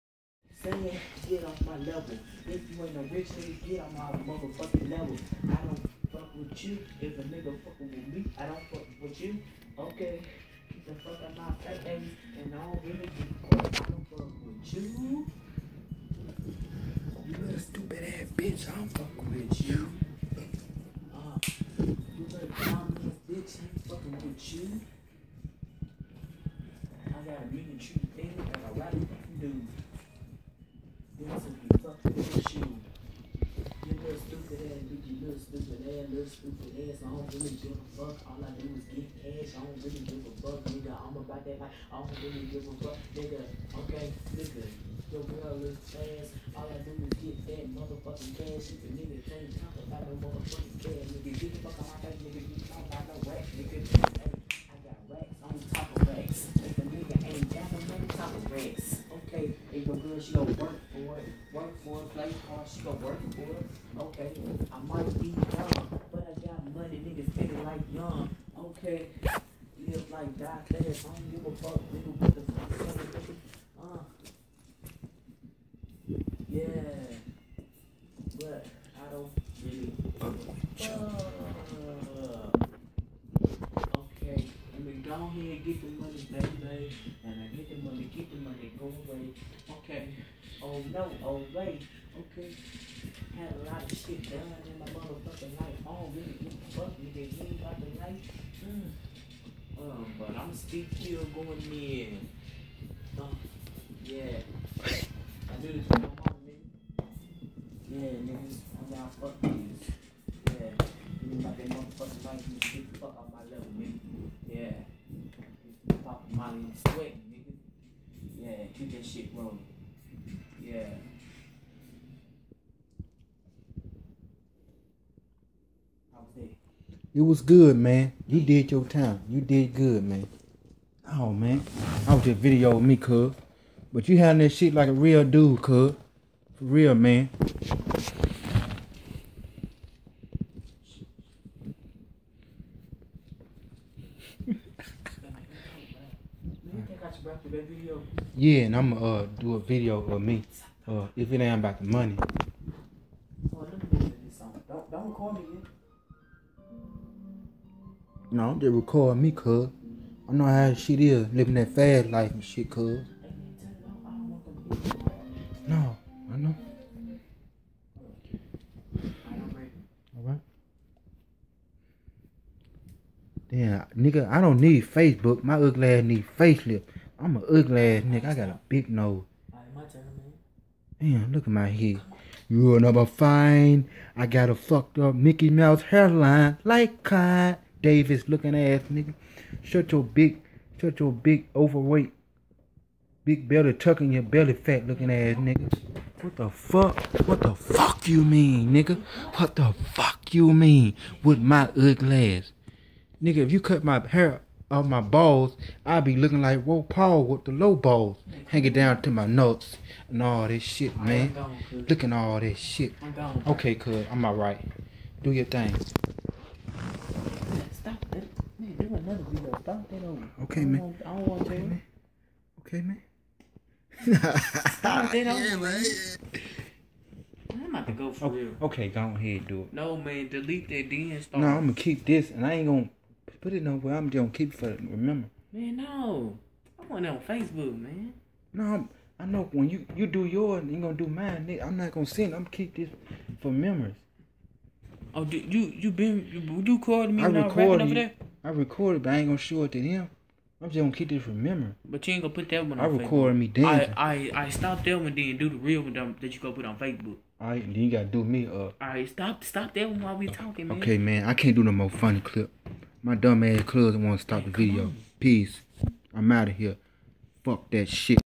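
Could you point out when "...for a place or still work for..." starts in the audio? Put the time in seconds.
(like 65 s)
61 s.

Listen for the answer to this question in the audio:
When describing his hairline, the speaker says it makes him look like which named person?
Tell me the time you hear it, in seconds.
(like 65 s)
187 s.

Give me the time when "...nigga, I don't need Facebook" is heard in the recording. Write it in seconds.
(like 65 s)
173 s.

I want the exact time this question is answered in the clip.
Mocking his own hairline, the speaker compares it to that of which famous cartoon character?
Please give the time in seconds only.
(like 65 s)
185 s.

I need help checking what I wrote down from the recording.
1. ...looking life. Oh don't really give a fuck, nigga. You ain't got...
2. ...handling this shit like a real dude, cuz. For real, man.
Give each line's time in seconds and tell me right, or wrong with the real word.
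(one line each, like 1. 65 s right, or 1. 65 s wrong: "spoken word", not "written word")
1. 94 s wrong: "motherfucking", not "looking"
2. 134 s right.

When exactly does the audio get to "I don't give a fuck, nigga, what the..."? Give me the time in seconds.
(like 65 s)
71 s.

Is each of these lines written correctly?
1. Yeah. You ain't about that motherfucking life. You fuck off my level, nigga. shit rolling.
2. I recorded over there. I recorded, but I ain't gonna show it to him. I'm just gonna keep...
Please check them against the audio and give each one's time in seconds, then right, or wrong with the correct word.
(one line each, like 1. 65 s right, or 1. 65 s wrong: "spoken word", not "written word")
1. 110 s right
2. 247 s right.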